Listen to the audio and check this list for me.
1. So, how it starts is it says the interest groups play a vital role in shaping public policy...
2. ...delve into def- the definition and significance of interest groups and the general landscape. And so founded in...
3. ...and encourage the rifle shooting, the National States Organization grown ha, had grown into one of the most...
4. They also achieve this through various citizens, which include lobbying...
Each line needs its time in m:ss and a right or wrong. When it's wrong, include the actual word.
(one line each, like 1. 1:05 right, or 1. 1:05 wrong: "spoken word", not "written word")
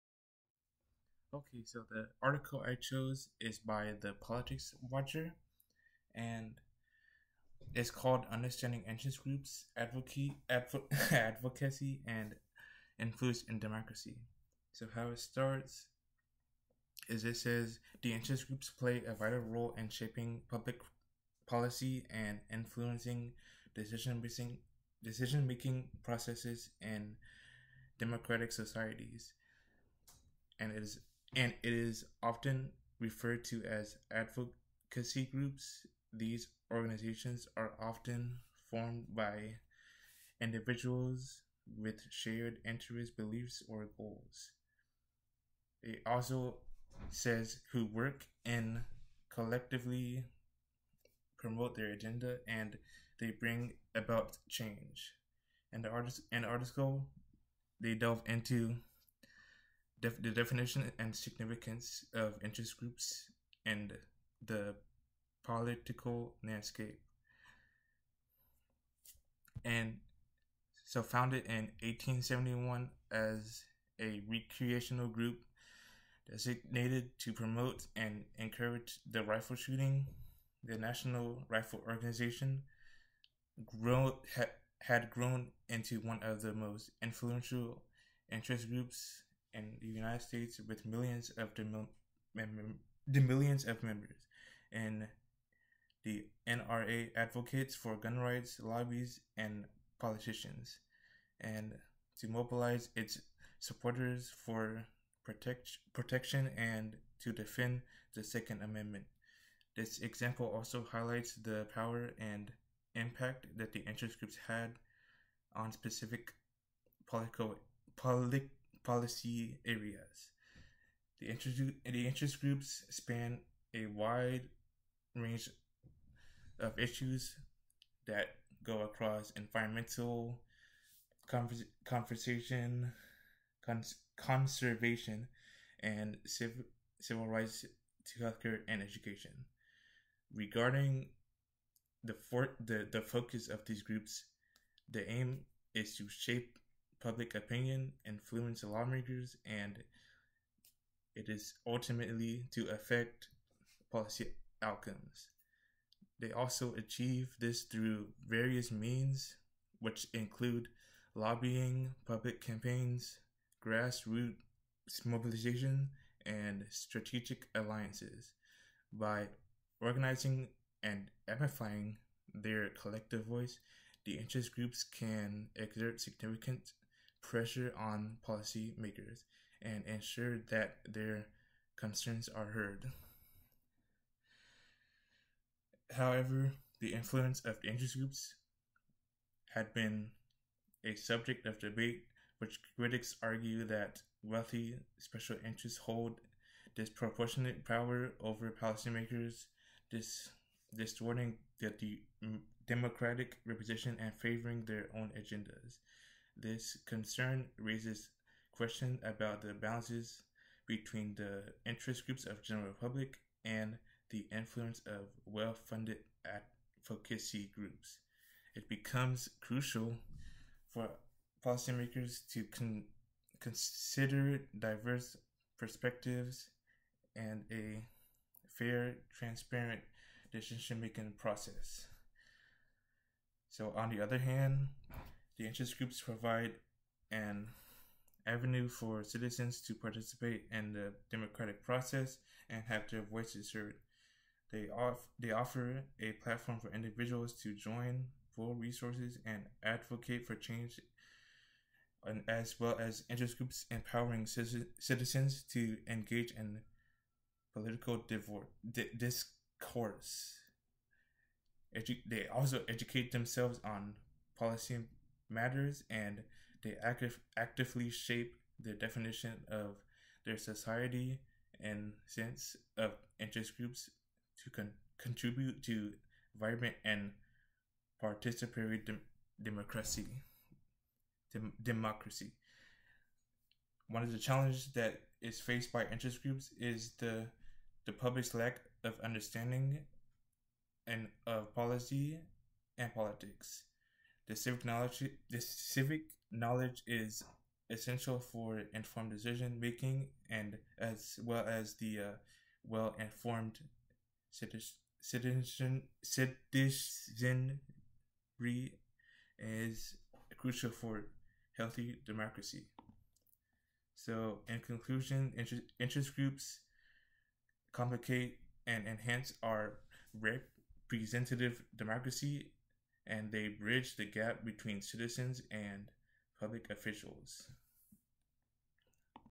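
1. 0:14 right
2. 0:57 wrong: "political", not "general"
3. 1:17 wrong: "Rifle", not "States"
4. 2:36 wrong: "means", not "citizens".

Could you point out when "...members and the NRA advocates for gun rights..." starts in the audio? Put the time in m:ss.
1:33.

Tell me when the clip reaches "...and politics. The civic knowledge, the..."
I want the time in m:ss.
4:52.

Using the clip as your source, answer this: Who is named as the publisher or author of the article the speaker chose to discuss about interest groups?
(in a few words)
Politics Watcher.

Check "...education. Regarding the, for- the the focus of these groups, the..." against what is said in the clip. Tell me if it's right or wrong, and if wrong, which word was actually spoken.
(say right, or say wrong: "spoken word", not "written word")
right.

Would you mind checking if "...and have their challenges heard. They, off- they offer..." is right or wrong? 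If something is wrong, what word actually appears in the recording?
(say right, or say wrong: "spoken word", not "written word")
wrong: "voices", not "challenges".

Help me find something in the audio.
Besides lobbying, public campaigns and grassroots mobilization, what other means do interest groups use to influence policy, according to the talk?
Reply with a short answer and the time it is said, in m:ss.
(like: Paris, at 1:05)
Strategic alliances, at 2:46.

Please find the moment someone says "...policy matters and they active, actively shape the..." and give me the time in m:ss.
4:24.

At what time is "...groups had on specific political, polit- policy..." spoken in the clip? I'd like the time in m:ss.
1:54.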